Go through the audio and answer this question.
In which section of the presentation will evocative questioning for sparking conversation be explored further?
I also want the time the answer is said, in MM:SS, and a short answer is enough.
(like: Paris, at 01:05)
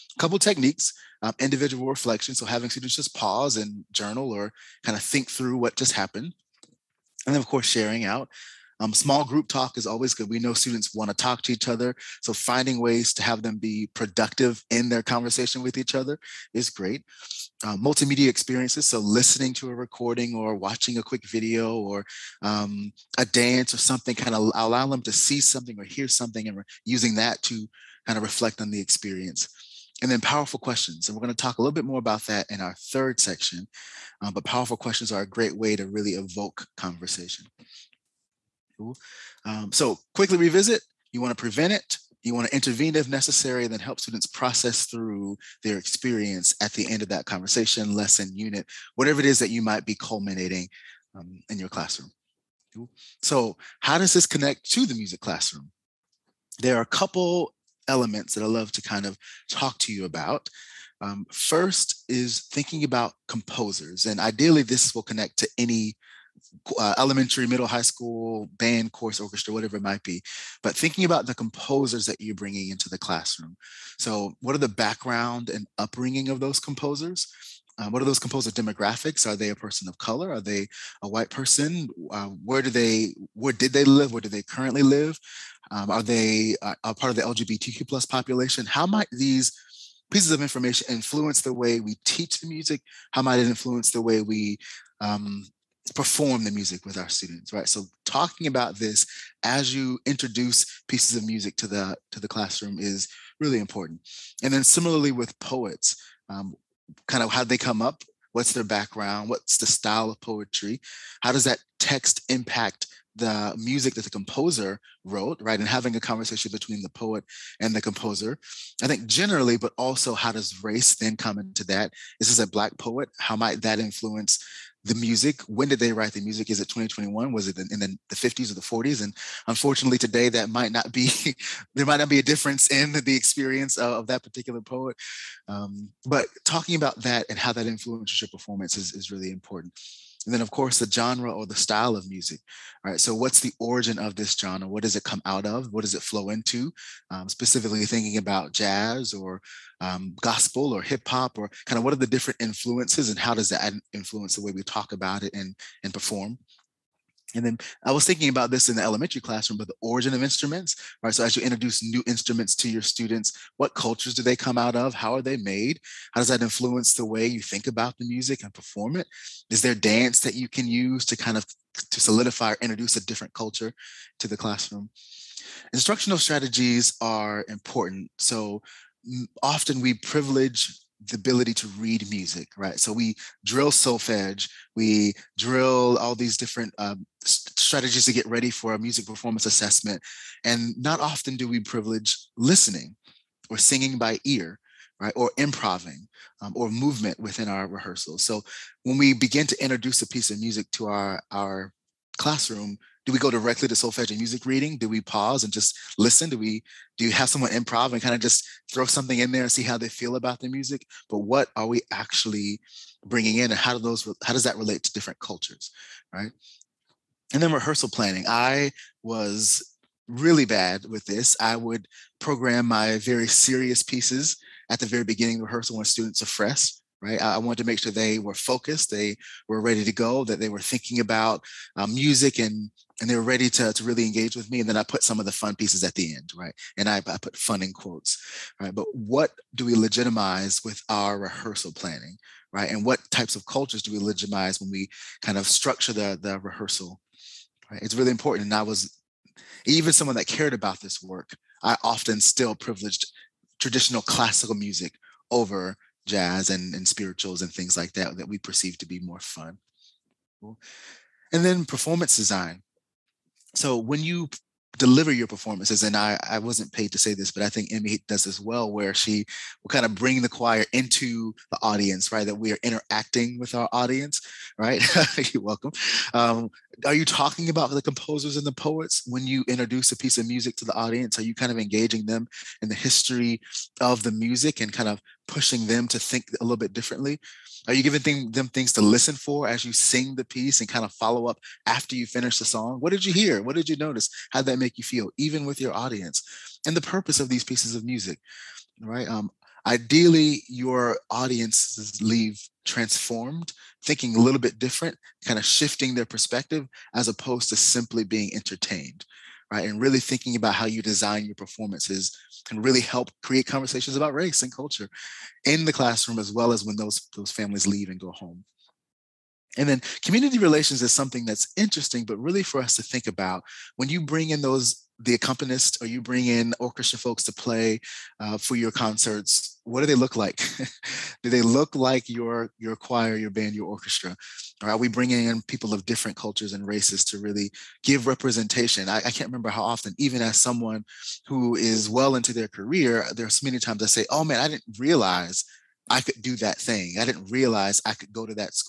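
third, at 00:32.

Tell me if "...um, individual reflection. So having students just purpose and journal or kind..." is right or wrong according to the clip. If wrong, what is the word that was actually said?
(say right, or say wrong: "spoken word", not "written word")
wrong: "pause", not "purpose".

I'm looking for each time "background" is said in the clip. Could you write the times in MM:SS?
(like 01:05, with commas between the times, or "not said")
01:14, 01:48.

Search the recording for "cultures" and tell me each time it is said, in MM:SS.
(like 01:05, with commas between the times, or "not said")
02:43, 02:53, 03:35, 04:03, 05:14, 05:36.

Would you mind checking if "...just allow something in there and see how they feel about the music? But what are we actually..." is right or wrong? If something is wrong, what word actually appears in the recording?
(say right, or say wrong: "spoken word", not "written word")
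wrong: "throw", not "allow".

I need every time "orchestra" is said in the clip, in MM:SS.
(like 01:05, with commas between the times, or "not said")
01:09, 05:26, 05:33.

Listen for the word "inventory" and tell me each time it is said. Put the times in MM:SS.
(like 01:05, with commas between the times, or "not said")
not said.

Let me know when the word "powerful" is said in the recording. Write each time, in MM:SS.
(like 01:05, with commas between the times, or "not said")
00:30, 00:34.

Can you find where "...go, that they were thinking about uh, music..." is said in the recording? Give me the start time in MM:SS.
03:49.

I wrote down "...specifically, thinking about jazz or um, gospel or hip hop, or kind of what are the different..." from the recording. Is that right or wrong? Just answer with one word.
right.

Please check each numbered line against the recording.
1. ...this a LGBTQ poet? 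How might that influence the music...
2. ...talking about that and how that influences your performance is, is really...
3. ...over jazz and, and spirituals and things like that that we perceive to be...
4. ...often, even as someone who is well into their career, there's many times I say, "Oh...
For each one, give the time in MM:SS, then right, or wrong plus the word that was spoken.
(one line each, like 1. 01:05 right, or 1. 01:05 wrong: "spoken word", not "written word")
1. 02:02 wrong: "Black", not "LGBTQ"
2. 02:16 right
3. 04:15 right
4. 05:39 right.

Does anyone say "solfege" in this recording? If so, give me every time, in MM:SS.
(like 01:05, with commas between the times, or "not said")
03:03, 03:23.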